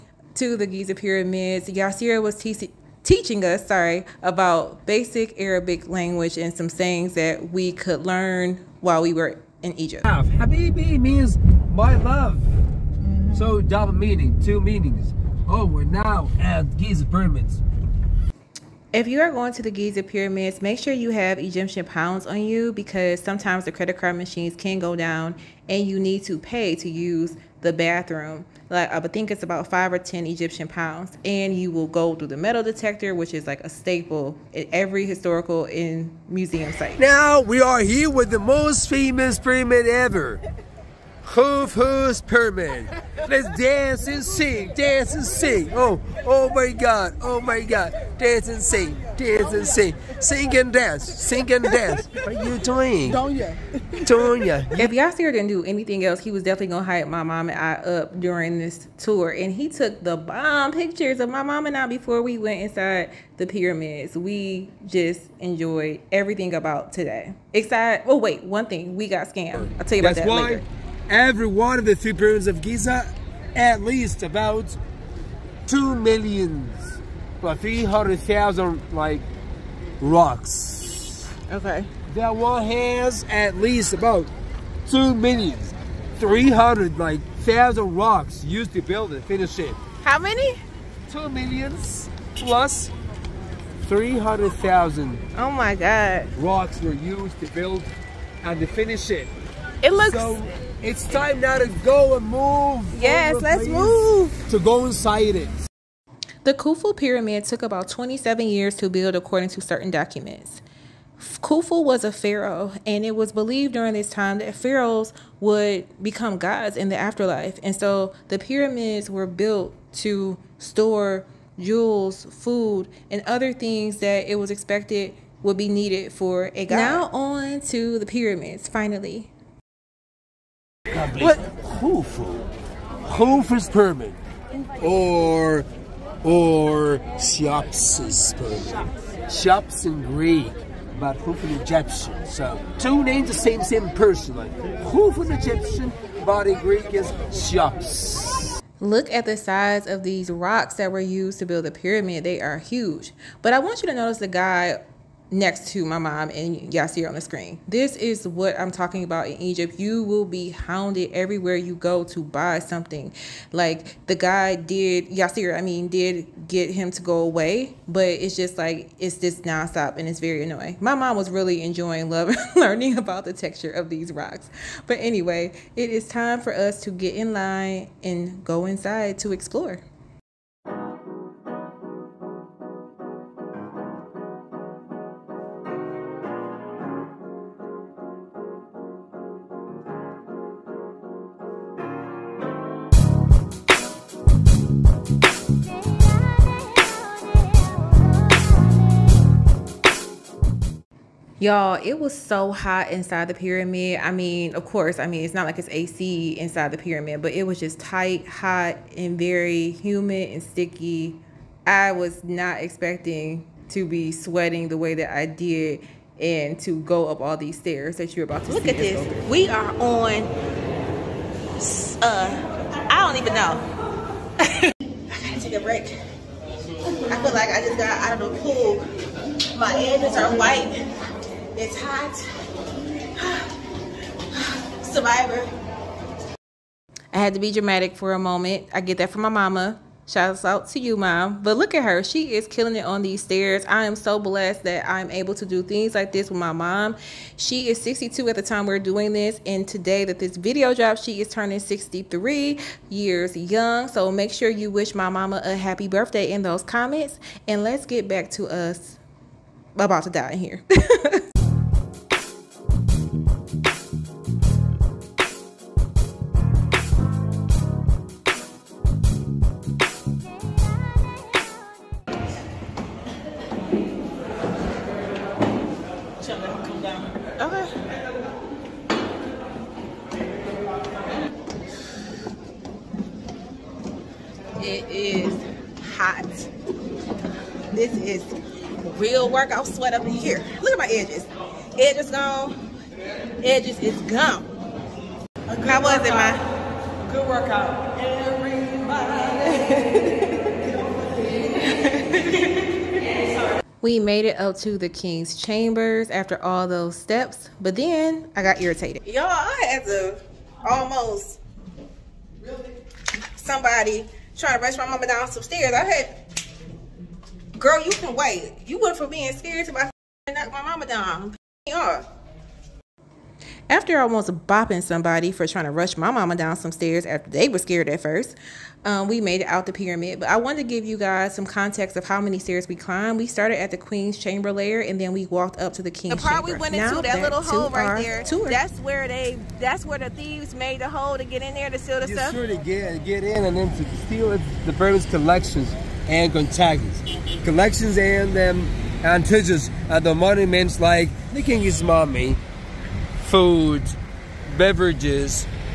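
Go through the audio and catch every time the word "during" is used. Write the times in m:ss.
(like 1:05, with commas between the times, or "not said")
0:58, 1:53.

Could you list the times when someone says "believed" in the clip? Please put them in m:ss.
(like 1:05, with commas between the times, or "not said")
1:53.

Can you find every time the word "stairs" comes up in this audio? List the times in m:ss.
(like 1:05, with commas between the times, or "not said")
3:37, 4:03, 5:15, 5:26, 5:32.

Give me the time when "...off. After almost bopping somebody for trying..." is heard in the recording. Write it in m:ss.
5:21.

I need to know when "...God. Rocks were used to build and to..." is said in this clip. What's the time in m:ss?
1:35.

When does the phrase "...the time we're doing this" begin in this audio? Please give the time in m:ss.
4:08.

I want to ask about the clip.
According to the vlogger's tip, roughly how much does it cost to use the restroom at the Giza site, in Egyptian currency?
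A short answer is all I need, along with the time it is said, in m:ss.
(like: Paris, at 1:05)
5 or 10 Egyptian pounds, at 0:29.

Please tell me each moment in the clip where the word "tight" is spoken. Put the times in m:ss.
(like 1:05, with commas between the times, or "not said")
3:27.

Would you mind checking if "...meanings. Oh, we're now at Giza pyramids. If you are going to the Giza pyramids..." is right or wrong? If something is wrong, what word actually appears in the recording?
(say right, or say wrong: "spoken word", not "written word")
right.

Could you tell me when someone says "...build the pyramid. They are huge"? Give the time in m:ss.
2:31.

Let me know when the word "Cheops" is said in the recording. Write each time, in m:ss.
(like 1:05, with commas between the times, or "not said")
2:19, 2:27.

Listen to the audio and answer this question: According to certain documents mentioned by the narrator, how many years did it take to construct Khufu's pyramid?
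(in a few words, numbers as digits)
27 years.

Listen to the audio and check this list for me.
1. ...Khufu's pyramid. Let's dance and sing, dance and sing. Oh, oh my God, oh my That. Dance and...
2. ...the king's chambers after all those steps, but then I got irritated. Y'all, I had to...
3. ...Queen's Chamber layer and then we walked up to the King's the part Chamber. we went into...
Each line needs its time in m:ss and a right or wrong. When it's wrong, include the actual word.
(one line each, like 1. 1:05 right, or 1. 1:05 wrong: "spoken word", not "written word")
1. 0:41 wrong: "God", not "That"
2. 5:04 right
3. 5:33 right.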